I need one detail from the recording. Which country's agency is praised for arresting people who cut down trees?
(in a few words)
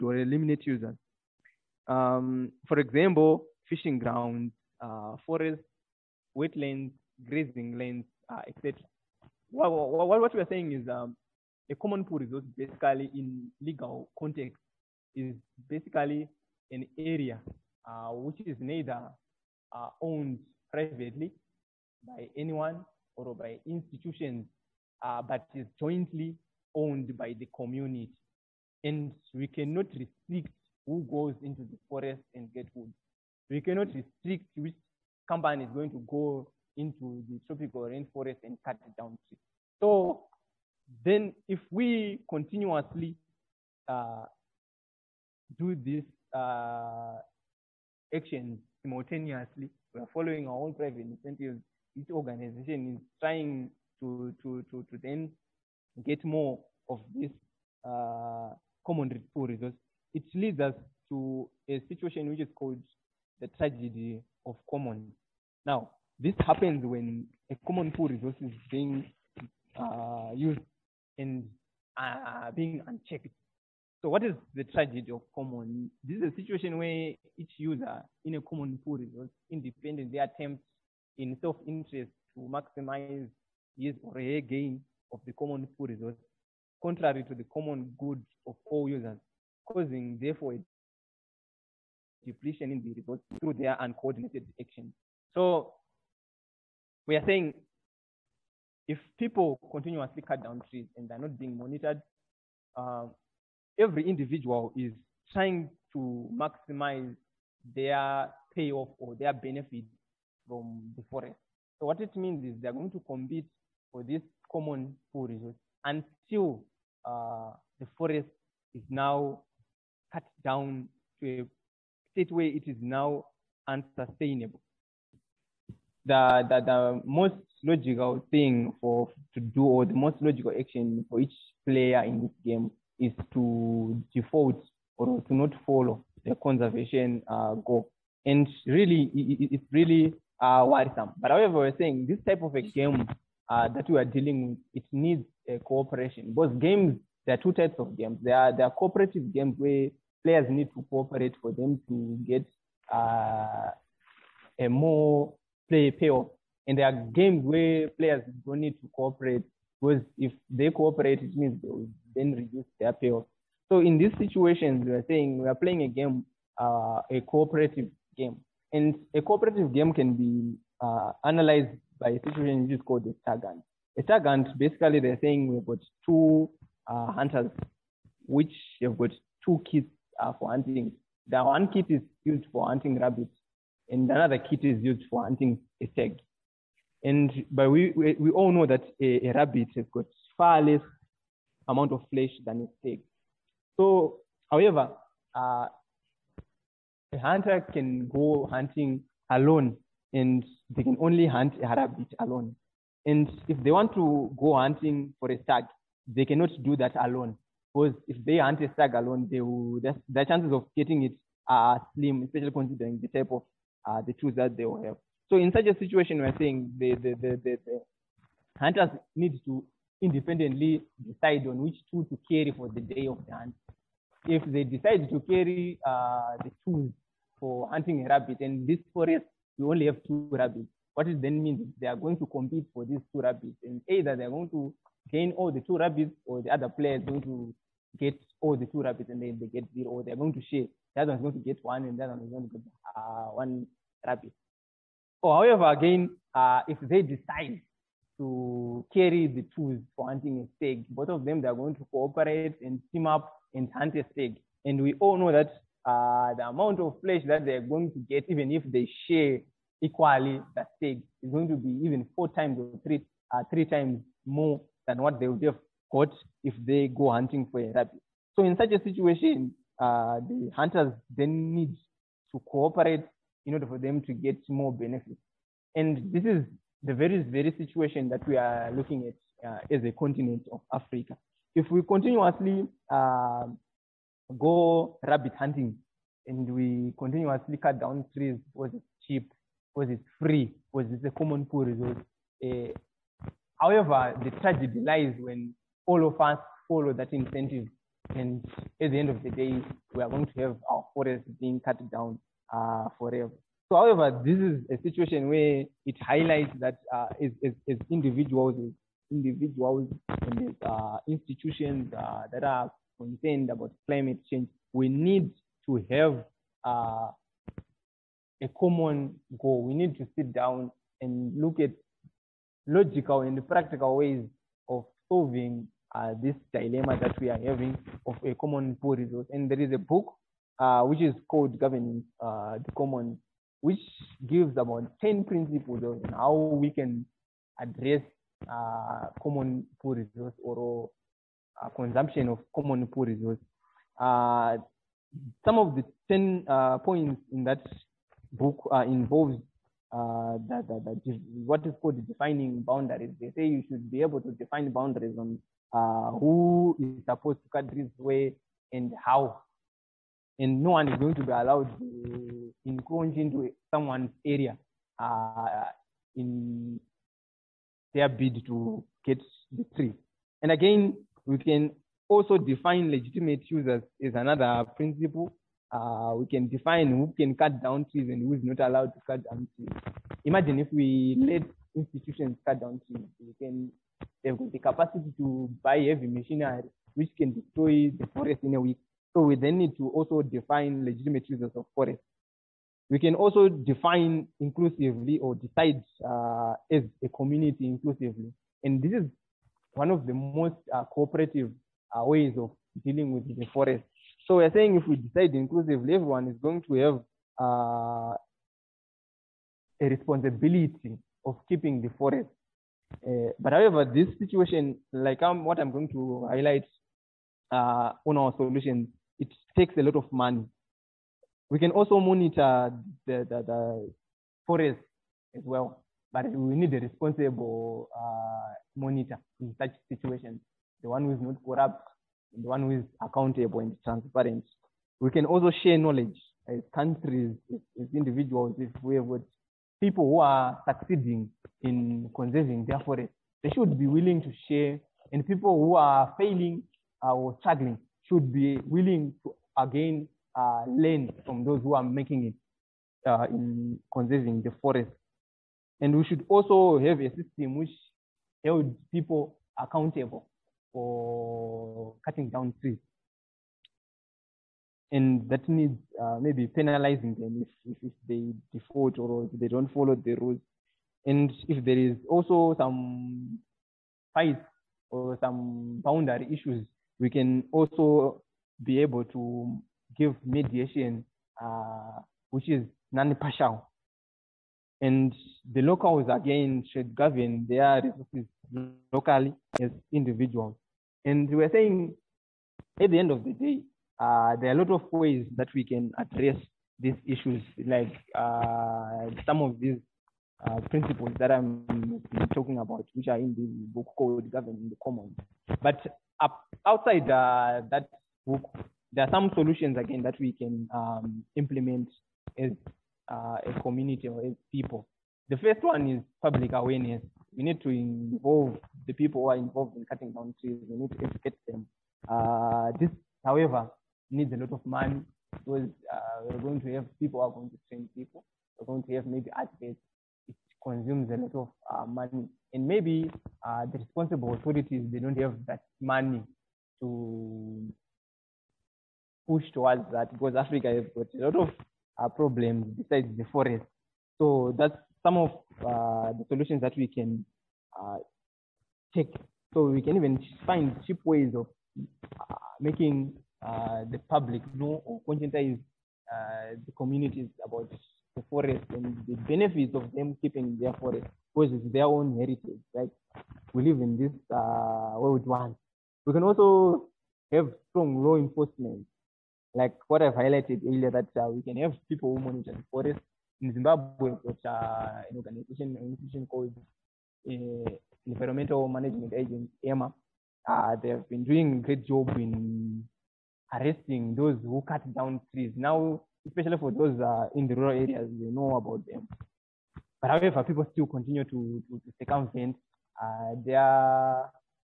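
Zimbabwe.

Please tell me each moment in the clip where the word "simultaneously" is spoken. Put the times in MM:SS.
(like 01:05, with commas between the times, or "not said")
00:48.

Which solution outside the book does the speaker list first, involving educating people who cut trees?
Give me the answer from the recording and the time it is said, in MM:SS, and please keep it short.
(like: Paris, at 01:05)
Public awareness, at 08:36.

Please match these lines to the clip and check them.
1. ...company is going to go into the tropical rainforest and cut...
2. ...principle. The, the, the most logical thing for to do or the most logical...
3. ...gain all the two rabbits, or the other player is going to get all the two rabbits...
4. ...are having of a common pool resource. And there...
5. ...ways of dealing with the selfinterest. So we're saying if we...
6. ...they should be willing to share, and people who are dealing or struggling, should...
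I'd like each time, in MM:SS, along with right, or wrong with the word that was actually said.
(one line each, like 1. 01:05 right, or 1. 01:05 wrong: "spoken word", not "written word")
1. 00:35 right
2. 02:03 wrong: "unsustainable", not "principle"
3. 03:55 right
4. 05:27 right
5. 06:42 wrong: "forest", not "selfinterest"
6. 07:23 wrong: "failing", not "dealing".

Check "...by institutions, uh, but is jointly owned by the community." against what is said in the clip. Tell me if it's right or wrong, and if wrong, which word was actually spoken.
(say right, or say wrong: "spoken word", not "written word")
right.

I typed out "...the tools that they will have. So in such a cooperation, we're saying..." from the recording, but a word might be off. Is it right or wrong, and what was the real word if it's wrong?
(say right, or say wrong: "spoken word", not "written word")
wrong: "situation", not "cooperation".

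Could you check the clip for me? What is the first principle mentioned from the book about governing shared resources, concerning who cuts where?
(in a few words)
Defining boundaries.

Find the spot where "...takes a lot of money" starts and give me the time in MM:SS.
06:59.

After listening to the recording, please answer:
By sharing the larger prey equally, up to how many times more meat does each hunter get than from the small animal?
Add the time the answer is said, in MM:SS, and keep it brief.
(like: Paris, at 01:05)
4 times, at 04:22.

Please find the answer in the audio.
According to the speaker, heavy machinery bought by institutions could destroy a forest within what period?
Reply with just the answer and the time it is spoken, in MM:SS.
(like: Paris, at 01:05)
A week, at 06:28.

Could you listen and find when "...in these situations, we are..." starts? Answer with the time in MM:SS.
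02:43.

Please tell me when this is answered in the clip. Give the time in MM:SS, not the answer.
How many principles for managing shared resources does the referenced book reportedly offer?
05:35.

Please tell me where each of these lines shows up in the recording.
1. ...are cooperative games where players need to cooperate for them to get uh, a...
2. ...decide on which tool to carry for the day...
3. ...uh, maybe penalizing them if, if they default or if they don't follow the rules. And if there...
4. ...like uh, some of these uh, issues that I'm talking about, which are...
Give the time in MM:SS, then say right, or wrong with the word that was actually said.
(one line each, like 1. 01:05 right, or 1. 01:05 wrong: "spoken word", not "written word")
1. 02:28 right
2. 03:41 right
3. 07:45 right
4. 08:17 wrong: "principles", not "issues".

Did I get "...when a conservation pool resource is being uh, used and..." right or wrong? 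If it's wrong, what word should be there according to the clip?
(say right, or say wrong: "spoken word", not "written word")
wrong: "common", not "conservation".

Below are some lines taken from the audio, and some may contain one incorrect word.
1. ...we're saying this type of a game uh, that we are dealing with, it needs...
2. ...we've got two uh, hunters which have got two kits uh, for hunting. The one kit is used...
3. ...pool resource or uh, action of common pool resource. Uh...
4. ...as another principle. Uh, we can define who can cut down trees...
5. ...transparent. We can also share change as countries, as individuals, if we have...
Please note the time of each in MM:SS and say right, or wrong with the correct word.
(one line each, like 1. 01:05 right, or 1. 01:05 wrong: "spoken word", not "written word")
1. 02:21 right
2. 02:55 right
3. 05:39 wrong: "consumption", not "action"
4. 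06:14 right
5. 07:13 wrong: "knowledge", not "change".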